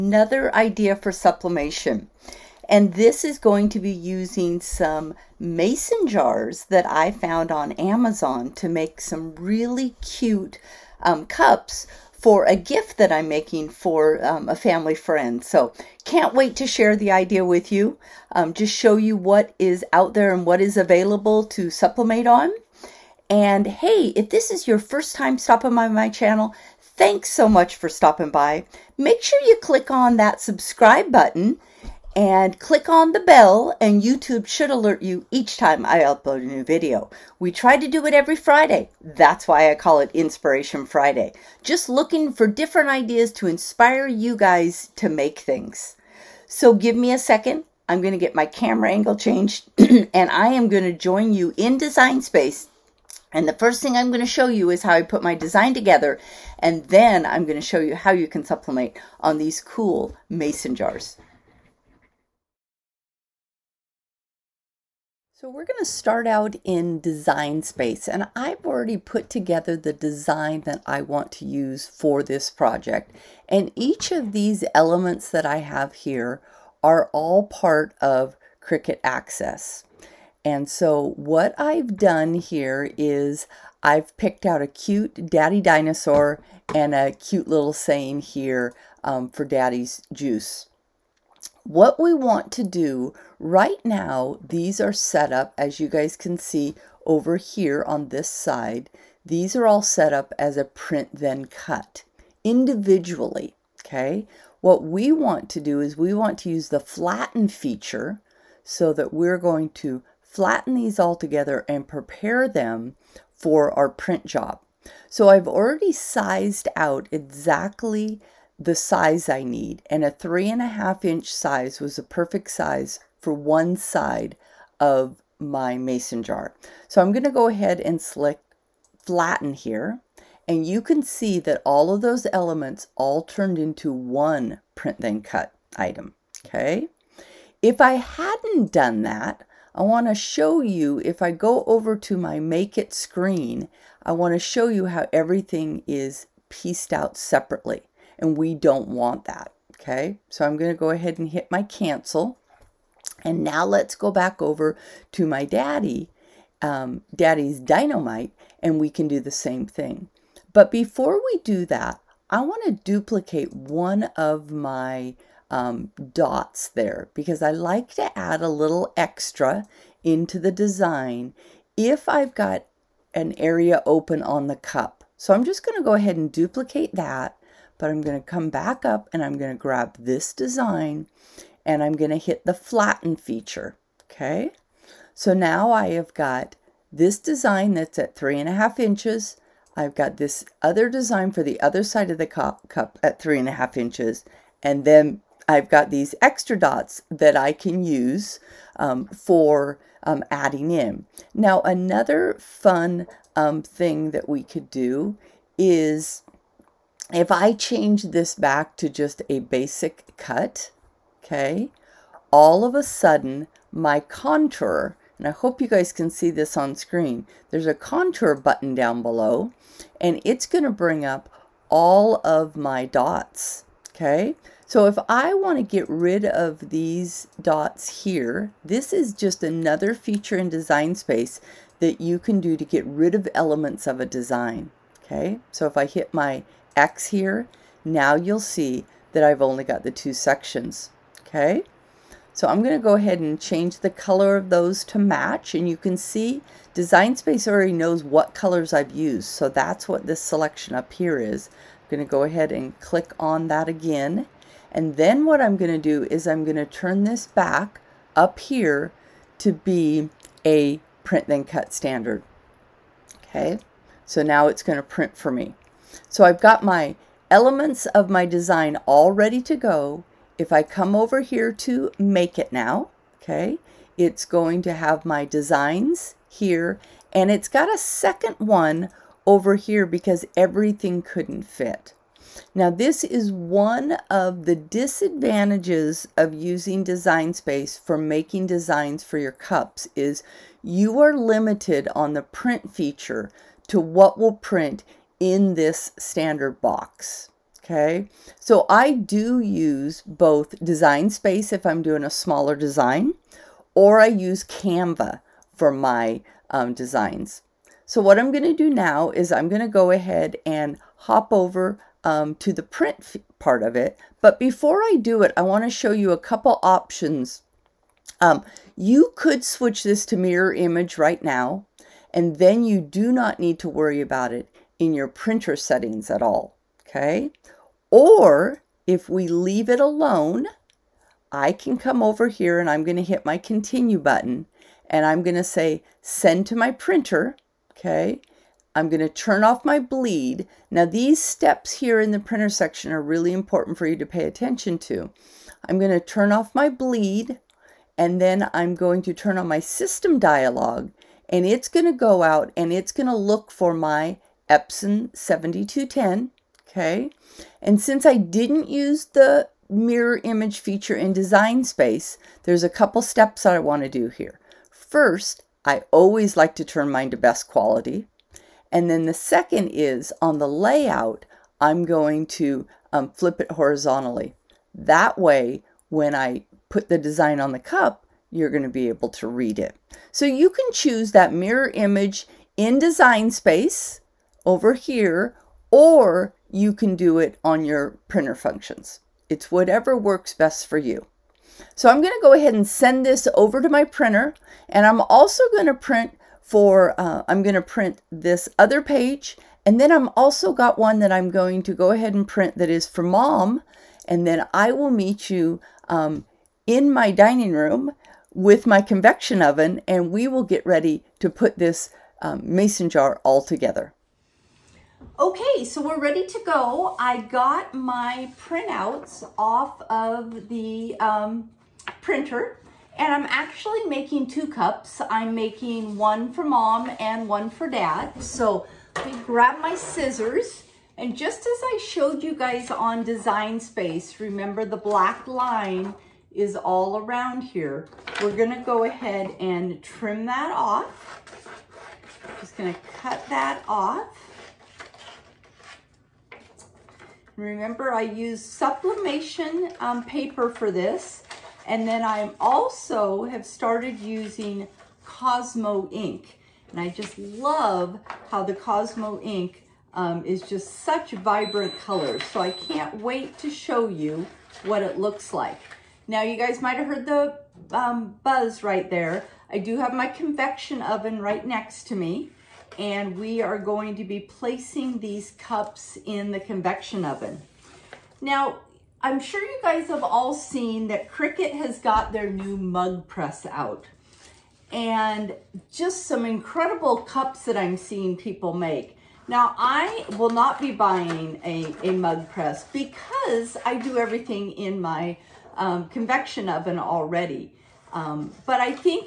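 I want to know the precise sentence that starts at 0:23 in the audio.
And hey, if this is your first time stopping by my channel, thanks so much for stopping by.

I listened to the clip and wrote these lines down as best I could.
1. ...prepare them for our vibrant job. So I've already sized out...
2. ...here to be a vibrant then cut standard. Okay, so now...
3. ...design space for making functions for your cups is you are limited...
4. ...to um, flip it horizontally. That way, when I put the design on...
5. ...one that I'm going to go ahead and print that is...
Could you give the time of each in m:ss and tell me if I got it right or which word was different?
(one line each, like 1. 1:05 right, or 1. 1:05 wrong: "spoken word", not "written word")
1. 1:51 wrong: "print", not "vibrant"
2. 4:18 wrong: "print", not "vibrant"
3. 4:46 wrong: "designs", not "functions"
4. 6:12 right
5. 6:40 right.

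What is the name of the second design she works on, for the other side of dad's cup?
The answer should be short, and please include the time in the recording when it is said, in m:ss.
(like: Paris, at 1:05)
daddy's dynamite, at 2:37.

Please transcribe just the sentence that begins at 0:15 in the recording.
So can't wait to share the idea with you.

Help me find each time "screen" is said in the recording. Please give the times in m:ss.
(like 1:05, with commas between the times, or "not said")
2:22, 3:36.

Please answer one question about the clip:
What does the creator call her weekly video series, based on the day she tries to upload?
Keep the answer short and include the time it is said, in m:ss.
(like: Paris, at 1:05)
Inspiration Friday, at 0:40.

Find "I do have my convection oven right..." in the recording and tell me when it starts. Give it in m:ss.
7:49.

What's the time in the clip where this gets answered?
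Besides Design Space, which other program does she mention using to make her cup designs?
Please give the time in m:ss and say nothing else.
5:04.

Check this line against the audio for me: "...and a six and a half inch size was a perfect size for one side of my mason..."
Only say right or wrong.
wrong.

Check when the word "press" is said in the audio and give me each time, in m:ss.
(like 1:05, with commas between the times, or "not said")
8:03, 8:12.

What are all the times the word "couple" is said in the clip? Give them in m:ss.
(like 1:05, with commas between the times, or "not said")
5:16, 6:02.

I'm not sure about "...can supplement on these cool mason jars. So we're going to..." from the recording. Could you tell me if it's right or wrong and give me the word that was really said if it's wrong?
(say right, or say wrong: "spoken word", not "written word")
right.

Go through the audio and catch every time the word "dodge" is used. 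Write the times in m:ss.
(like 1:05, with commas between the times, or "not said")
not said.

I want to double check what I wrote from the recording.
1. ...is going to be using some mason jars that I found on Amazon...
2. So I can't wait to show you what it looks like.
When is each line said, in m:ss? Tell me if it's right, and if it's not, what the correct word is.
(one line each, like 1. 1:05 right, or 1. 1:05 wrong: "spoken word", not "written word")
1. 0:03 right
2. 7:42 right.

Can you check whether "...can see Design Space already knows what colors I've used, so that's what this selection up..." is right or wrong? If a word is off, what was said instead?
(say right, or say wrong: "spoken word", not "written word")
right.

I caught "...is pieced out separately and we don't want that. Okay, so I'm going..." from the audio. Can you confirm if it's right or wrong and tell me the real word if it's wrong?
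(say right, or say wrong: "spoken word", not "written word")
right.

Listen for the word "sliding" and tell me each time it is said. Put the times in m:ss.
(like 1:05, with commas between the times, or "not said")
not said.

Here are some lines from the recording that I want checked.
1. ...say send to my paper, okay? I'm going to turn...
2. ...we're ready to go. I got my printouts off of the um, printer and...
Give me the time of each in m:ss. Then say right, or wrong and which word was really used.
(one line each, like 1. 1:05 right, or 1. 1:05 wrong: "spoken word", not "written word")
1. 5:35 wrong: "printer", not "paper"
2. 6:55 right.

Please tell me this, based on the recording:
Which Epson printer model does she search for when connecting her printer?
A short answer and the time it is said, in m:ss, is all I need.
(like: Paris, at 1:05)
Epson 7210, at 5:54.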